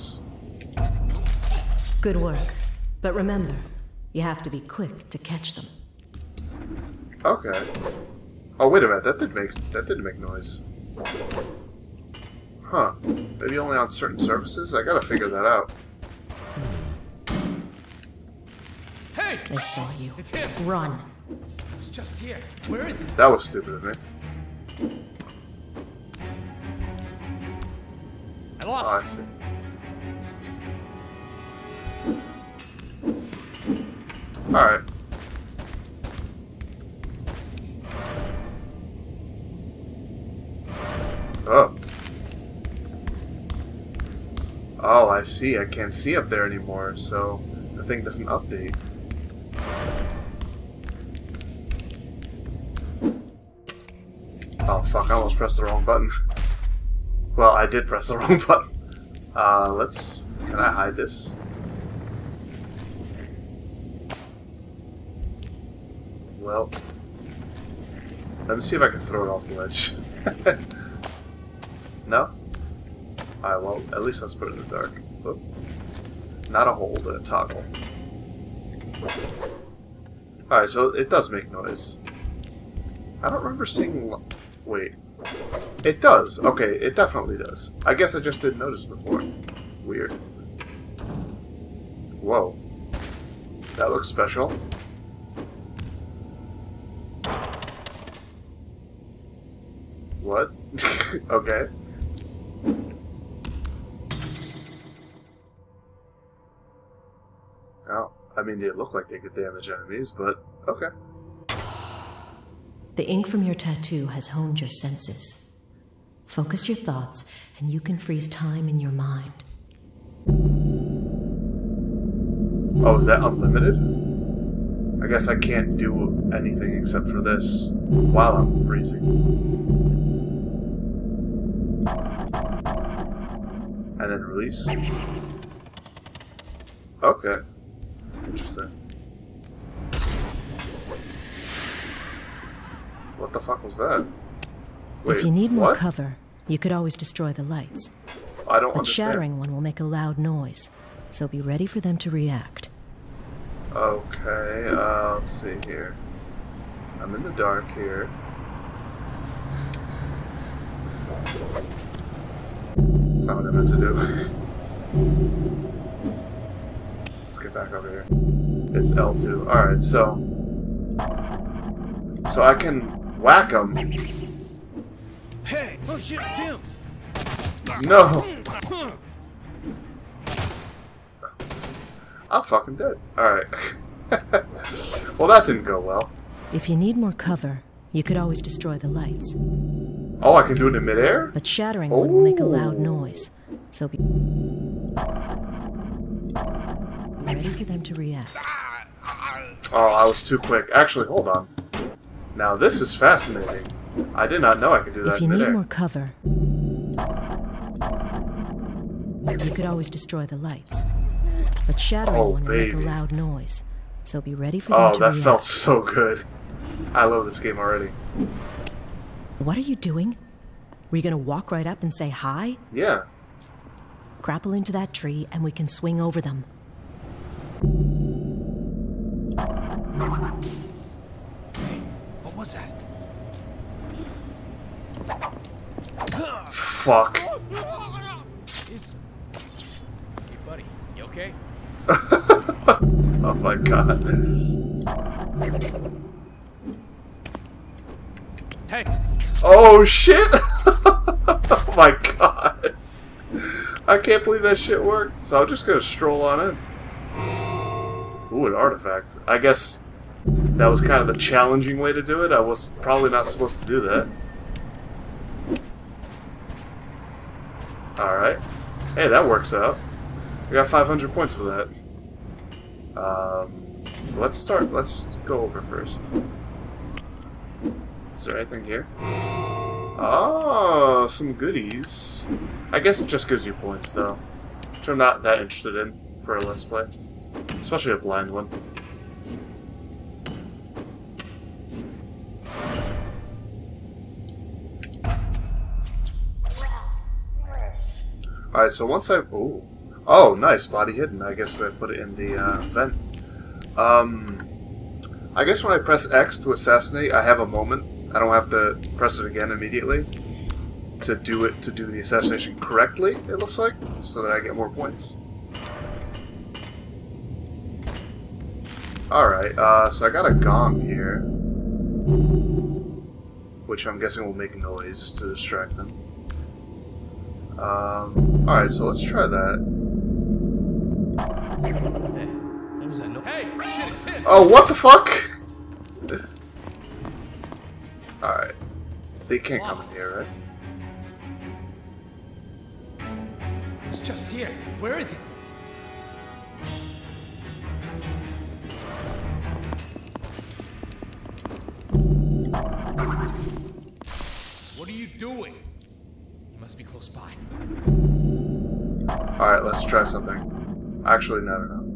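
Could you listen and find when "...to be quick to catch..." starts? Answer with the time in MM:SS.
00:04.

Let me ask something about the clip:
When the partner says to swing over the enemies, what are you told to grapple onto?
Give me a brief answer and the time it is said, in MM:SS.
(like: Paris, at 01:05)
that tree, at 03:44.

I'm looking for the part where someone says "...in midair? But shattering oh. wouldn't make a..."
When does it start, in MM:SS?
03:10.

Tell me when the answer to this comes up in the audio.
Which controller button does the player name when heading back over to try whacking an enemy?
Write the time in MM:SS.
02:48.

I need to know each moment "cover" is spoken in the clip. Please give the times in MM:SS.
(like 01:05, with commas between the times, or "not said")
02:25, 03:07, 03:25.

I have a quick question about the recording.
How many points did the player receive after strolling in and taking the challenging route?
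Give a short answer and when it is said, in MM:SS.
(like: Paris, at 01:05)
500, at 04:30.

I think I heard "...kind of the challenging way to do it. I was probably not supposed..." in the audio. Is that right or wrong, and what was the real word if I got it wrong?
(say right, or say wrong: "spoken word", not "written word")
right.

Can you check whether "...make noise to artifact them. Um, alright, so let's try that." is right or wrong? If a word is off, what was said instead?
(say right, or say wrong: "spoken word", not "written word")
wrong: "distract", not "artifact".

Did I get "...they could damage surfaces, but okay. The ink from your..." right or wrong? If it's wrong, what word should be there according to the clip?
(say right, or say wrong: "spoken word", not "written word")
wrong: "enemies", not "surfaces".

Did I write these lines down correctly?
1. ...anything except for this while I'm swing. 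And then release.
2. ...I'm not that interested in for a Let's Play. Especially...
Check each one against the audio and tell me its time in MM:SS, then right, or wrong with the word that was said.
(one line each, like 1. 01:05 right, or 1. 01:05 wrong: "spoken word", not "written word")
1. 02:06 wrong: "freezing", not "swing"
2. 04:44 right.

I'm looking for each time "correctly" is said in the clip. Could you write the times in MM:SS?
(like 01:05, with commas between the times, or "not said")
05:12.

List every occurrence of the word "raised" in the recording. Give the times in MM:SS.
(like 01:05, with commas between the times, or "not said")
not said.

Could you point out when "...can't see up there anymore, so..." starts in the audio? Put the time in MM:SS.
00:45.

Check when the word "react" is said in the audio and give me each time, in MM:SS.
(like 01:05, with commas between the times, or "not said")
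02:32, 03:17, 03:35.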